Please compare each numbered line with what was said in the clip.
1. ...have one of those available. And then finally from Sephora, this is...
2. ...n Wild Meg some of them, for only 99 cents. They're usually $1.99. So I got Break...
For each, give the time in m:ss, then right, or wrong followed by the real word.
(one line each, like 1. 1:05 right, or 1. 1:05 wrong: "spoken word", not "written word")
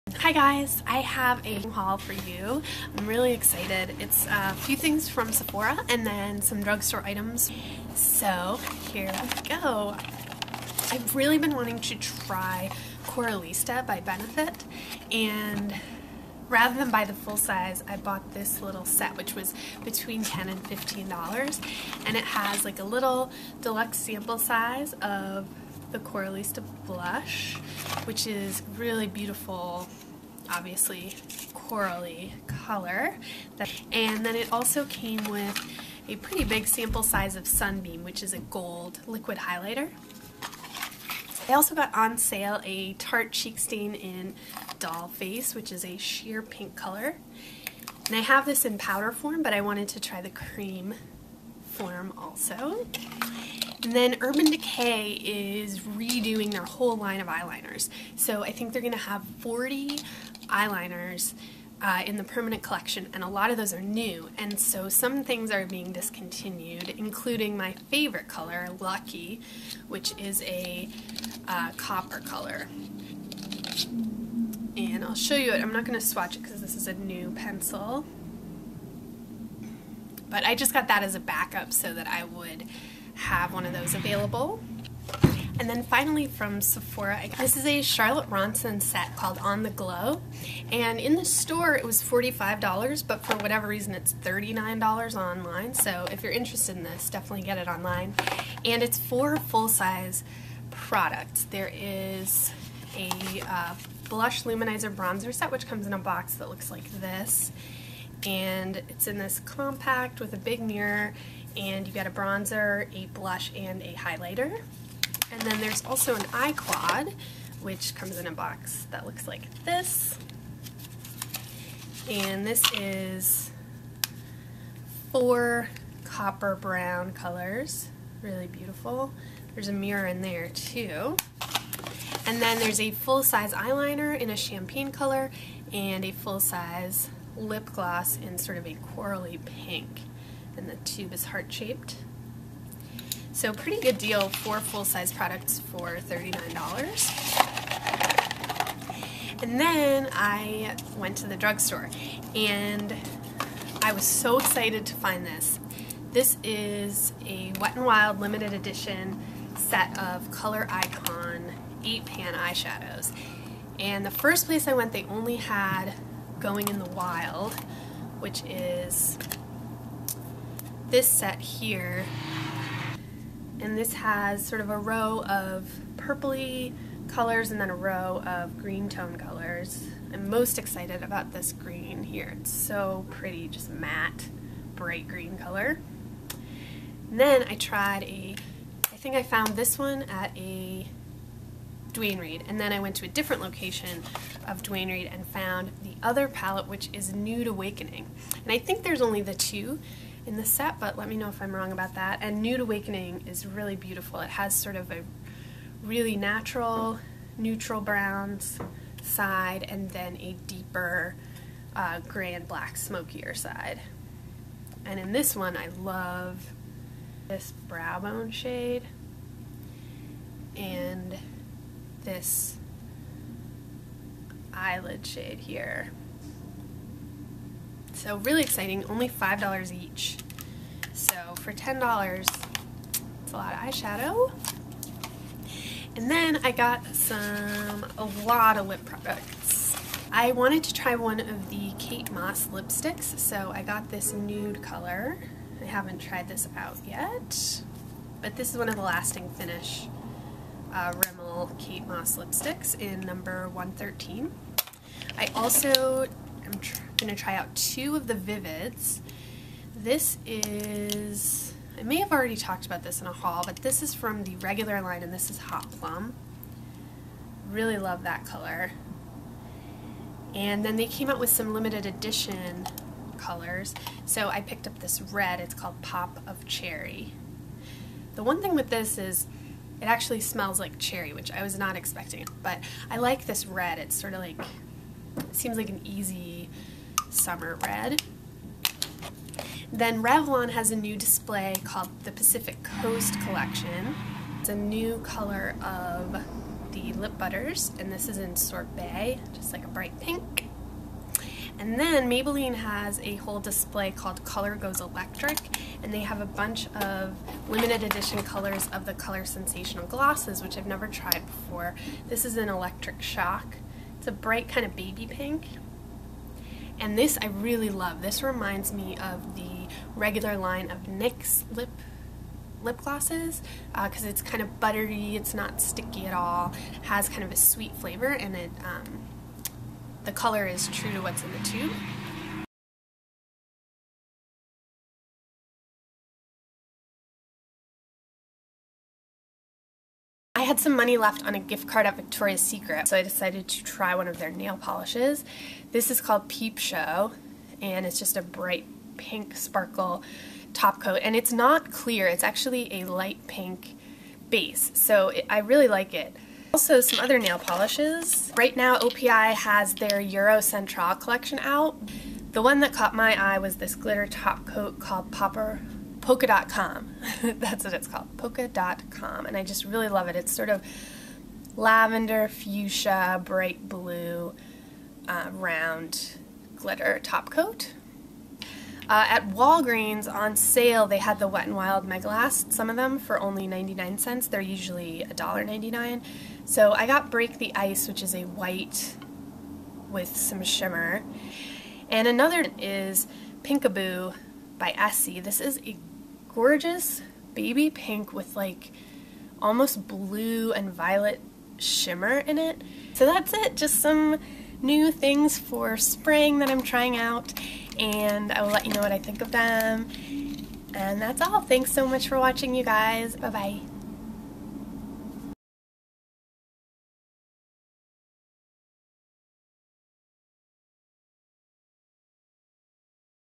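1. 1:23 right
2. 6:21 right.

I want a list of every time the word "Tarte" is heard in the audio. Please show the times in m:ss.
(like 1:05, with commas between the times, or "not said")
0:42.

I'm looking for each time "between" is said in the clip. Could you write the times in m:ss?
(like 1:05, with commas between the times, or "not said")
0:19.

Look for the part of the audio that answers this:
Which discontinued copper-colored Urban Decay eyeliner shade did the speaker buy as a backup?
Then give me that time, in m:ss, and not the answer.
1:08.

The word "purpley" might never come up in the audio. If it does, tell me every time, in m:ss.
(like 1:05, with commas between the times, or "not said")
2:55.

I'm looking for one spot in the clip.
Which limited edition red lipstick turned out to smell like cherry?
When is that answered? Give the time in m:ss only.
4:35.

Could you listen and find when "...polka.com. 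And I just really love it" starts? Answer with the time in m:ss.
6:08.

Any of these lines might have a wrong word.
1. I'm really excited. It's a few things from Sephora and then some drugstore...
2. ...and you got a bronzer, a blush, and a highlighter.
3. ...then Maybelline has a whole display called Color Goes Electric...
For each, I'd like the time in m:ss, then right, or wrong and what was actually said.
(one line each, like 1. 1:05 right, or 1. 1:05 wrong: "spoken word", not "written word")
1. 0:02 right
2. 1:51 right
3. 5:01 right.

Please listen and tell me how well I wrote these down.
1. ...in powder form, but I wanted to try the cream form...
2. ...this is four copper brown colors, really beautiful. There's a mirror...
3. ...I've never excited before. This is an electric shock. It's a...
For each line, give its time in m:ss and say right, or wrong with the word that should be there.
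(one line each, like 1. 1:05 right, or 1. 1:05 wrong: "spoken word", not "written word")
1. 0:48 right
2. 2:02 right
3. 5:10 wrong: "tried", not "excited".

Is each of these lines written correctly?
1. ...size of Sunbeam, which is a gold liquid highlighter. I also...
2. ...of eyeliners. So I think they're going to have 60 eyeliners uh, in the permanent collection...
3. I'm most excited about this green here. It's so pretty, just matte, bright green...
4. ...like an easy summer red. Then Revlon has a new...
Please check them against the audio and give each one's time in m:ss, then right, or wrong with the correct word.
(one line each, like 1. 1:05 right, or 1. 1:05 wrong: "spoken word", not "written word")
1. 0:37 right
2. 0:57 wrong: "40", not "60"
3. 3:00 right
4. 4:45 right.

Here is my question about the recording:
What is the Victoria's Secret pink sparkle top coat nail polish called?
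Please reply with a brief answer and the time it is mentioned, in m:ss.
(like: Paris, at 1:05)
Peep Show, at 5:46.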